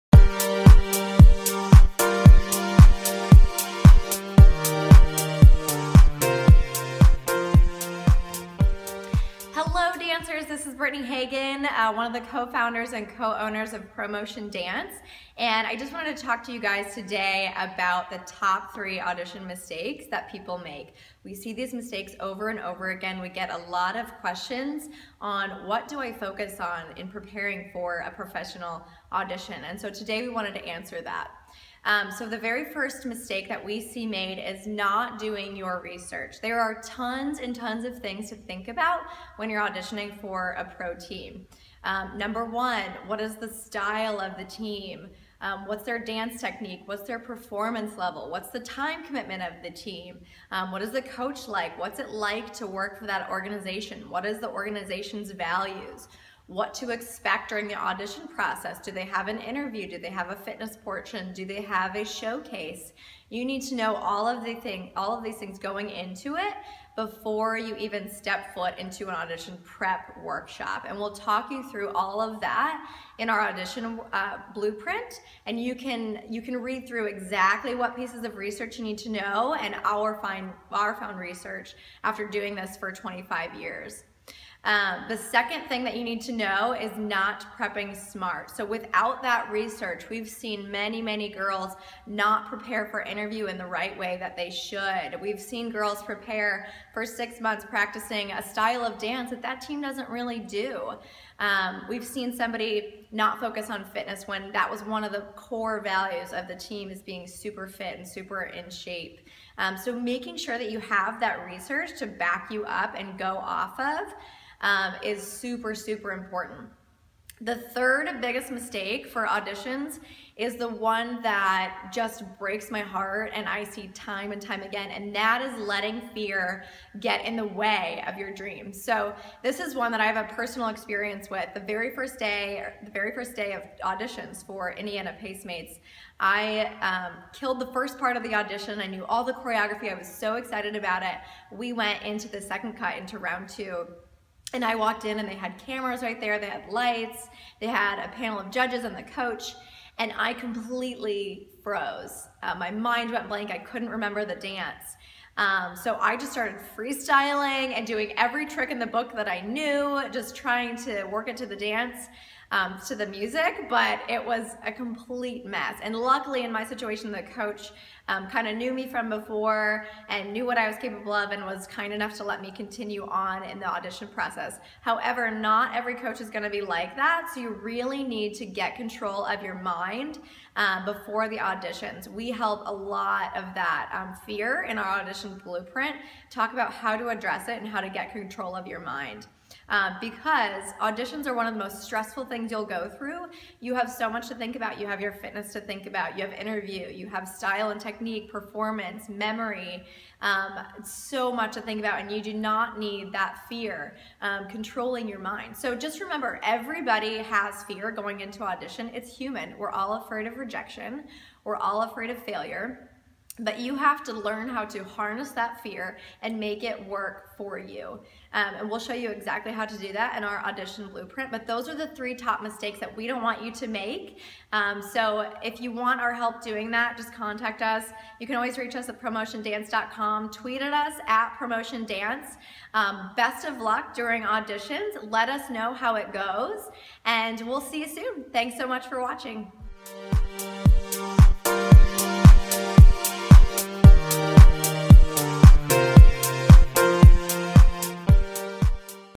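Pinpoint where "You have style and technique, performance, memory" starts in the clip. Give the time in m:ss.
3:16.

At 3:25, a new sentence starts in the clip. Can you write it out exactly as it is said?
So just remember, everybody has fear going into audition.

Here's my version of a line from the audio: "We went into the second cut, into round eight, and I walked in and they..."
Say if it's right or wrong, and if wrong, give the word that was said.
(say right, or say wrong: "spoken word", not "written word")
wrong: "two", not "eight".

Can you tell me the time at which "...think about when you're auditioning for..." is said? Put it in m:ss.
0:38.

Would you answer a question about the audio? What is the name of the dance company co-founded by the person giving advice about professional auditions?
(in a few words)
ProMotion Dance.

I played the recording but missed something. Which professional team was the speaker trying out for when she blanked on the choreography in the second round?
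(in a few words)
Indiana Pacemates.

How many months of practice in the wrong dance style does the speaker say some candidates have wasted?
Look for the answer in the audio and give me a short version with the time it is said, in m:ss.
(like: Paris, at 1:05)
6, at 1:37.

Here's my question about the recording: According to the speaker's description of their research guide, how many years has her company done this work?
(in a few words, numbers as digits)
25.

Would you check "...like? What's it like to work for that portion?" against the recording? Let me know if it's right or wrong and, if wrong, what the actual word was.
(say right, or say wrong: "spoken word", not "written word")
wrong: "organization", not "portion".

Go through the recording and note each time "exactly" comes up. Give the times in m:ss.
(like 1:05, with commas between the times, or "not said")
1:17, 3:39.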